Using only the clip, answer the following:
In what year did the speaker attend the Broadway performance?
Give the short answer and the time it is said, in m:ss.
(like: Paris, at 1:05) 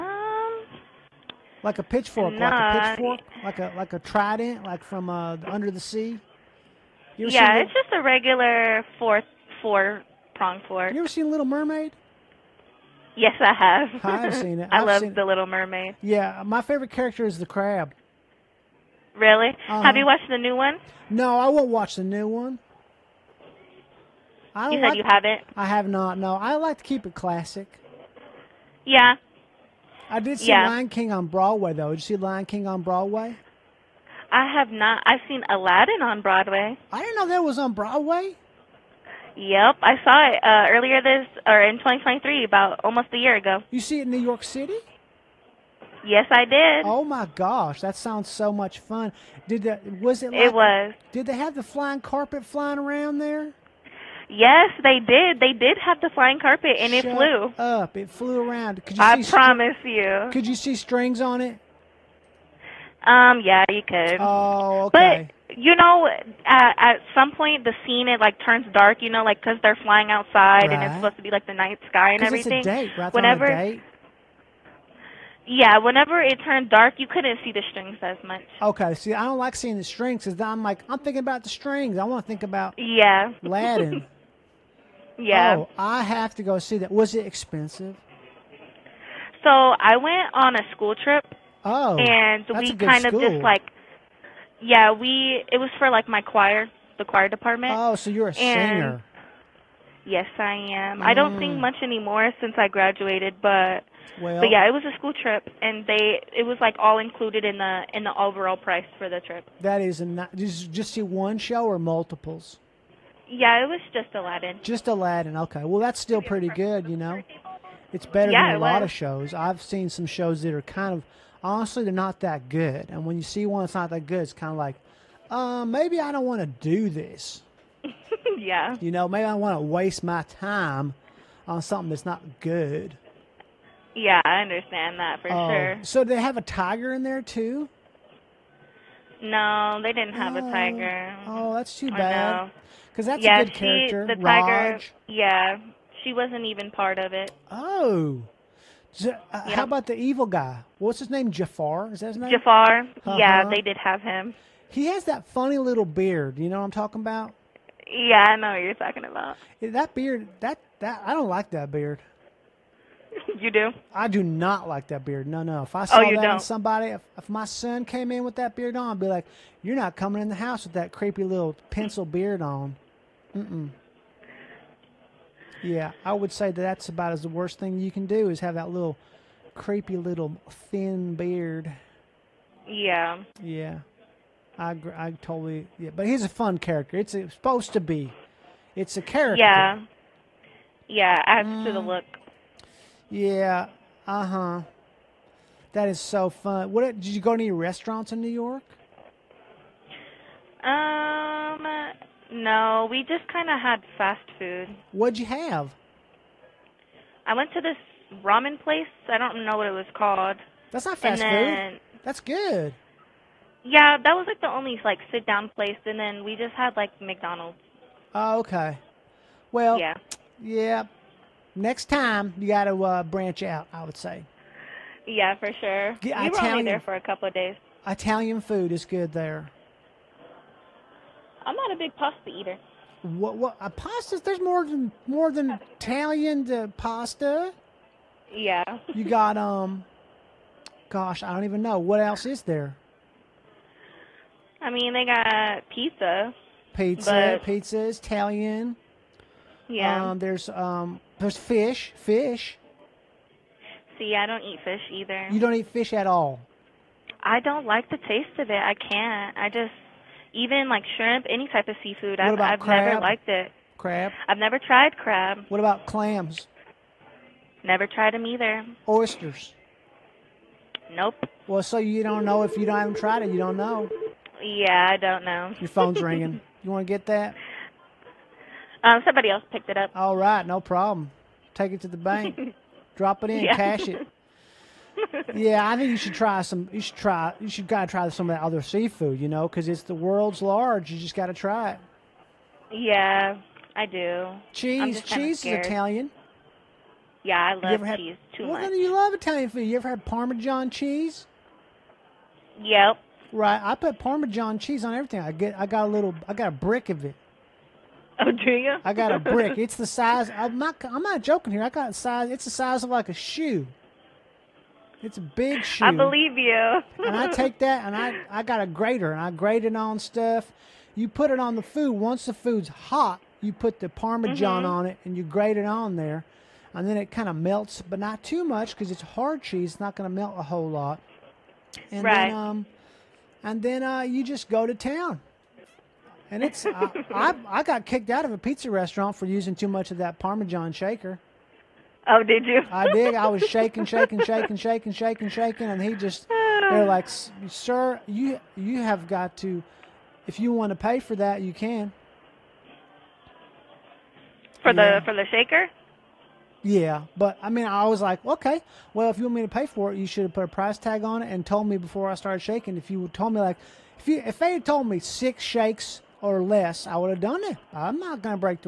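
2023, at 0:41.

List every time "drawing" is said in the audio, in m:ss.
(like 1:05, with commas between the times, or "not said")
not said.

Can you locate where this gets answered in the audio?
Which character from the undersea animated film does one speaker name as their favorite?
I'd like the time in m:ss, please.
0:17.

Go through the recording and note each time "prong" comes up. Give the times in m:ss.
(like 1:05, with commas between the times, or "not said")
0:10.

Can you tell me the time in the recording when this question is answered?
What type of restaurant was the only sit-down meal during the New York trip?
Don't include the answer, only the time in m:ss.
3:28.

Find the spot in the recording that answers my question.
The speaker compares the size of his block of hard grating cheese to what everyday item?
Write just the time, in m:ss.
5:13.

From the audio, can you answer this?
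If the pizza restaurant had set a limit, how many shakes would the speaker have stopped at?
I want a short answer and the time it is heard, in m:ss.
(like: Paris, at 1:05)
6, at 6:04.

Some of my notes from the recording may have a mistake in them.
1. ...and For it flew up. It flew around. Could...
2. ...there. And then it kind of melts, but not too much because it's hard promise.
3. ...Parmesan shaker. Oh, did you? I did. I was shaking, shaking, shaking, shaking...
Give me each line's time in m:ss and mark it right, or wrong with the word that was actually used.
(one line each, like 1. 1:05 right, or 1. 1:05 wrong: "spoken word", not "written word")
1. 0:56 wrong: "Shut", not "For"
2. 5:25 wrong: "cheese", not "promise"
3. 5:40 right.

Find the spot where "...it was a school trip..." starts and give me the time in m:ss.
1:44.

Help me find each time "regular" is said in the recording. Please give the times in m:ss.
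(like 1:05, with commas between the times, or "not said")
0:08.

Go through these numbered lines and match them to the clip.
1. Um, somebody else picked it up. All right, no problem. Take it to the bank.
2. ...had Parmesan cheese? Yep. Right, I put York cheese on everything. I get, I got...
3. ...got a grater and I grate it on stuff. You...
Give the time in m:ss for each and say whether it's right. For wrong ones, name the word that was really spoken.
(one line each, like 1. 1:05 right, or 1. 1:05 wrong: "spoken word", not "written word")
1. 4:38 right
2. 4:59 wrong: "Parmesan", not "York"
3. 5:18 right.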